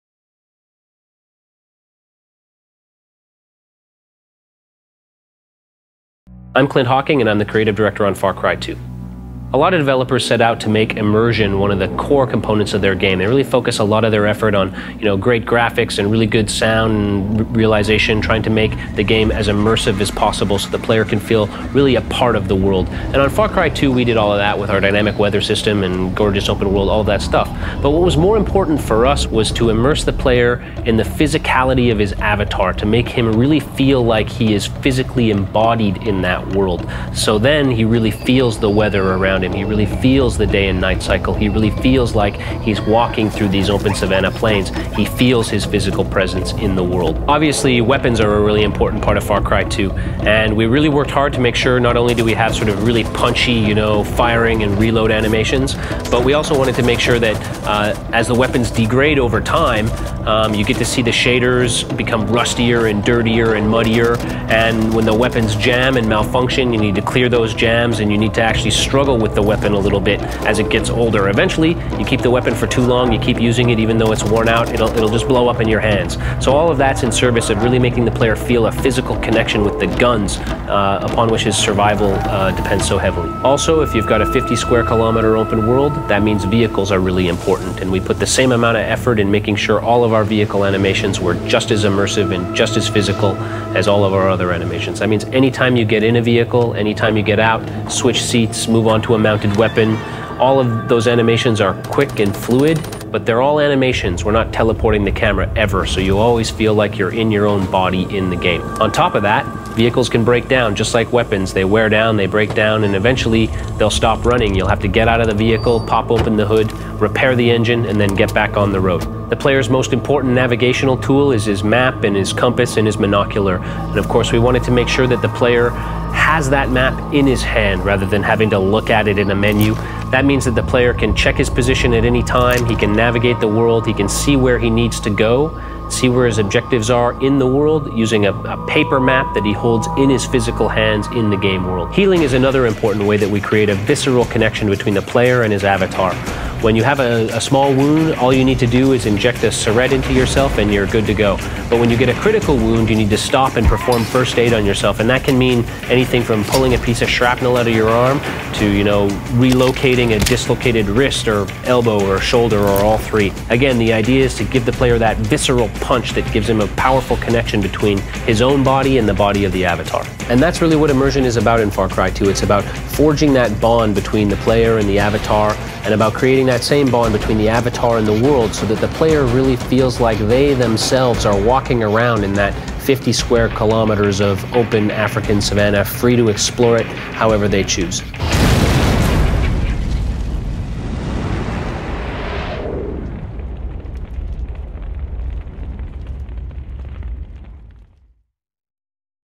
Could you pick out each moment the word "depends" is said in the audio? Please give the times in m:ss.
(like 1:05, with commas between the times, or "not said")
1:22.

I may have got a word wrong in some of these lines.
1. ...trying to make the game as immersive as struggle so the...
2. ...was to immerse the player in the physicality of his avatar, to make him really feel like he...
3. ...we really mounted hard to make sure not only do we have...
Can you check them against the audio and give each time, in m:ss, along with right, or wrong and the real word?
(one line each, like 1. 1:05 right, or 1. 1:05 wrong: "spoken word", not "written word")
1. 0:18 wrong: "possible", not "struggle"
2. 0:29 right
3. 0:50 wrong: "worked", not "mounted".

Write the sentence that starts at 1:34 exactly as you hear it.
That means anytime you get in a vehicle, anytime you get out, switch seats, move on to a mounted weapon.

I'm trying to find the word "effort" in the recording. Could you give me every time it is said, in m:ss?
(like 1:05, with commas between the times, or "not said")
0:14, 1:28.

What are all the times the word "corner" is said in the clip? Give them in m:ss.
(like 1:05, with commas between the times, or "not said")
not said.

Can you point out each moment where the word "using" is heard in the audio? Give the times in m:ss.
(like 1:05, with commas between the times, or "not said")
1:13, 2:17.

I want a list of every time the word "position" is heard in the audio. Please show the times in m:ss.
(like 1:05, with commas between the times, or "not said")
2:11.